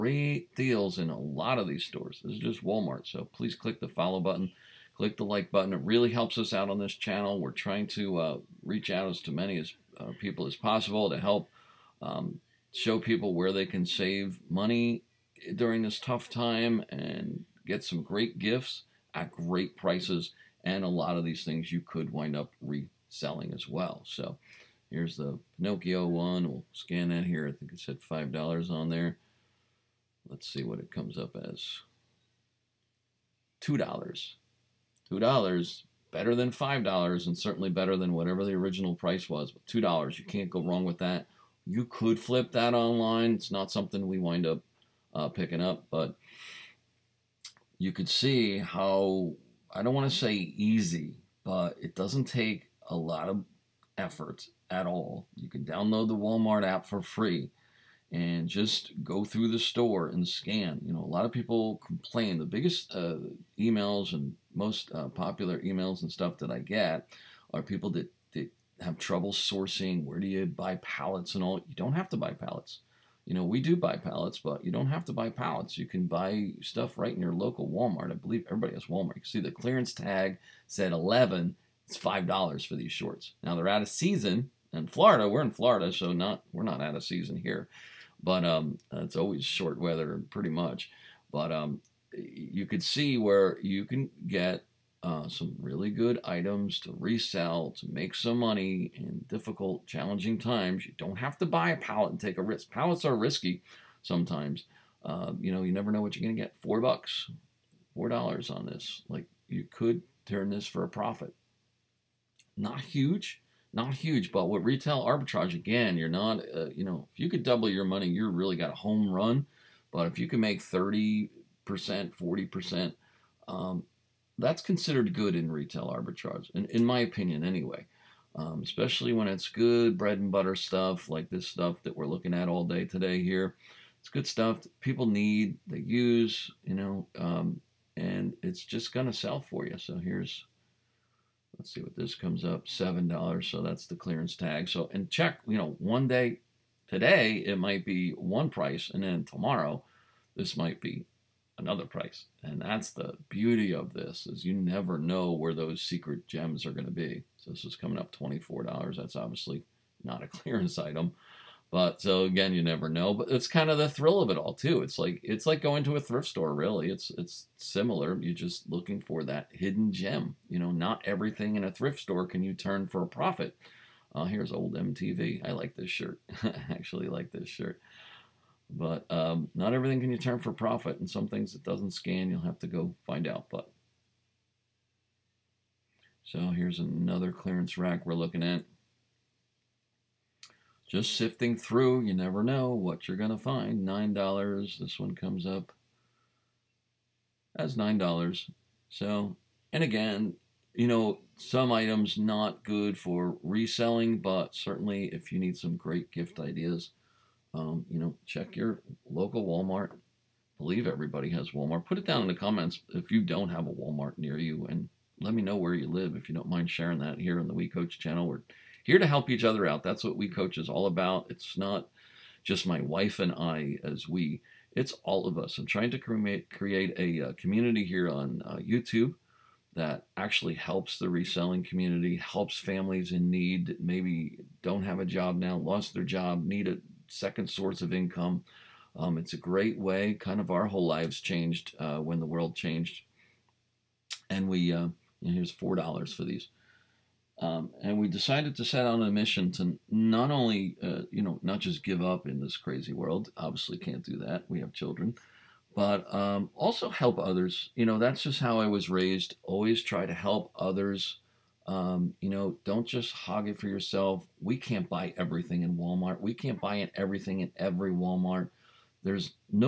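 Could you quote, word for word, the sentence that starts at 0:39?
But $2, you can't go wrong with that.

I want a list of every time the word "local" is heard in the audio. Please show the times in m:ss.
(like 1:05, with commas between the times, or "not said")
1:17, 3:29.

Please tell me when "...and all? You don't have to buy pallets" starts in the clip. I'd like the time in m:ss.
1:11.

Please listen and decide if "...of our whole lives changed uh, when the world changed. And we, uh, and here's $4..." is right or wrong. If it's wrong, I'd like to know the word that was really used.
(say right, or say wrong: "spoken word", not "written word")
right.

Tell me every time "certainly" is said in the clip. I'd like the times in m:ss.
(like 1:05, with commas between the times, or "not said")
0:37, 3:24.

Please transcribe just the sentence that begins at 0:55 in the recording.
You can download the Walmart app for free and just go through the store and scan.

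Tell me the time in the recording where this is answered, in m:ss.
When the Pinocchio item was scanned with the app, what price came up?
0:33.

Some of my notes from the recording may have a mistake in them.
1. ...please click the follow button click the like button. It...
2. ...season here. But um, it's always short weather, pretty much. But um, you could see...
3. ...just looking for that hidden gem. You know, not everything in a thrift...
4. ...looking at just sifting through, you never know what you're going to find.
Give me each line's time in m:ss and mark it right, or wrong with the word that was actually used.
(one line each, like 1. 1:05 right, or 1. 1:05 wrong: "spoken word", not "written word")
1. 0:03 right
2. 1:27 right
3. 2:48 right
4. 3:08 right.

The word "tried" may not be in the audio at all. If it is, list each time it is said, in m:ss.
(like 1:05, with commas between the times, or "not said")
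not said.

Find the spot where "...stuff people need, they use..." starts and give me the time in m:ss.
2:14.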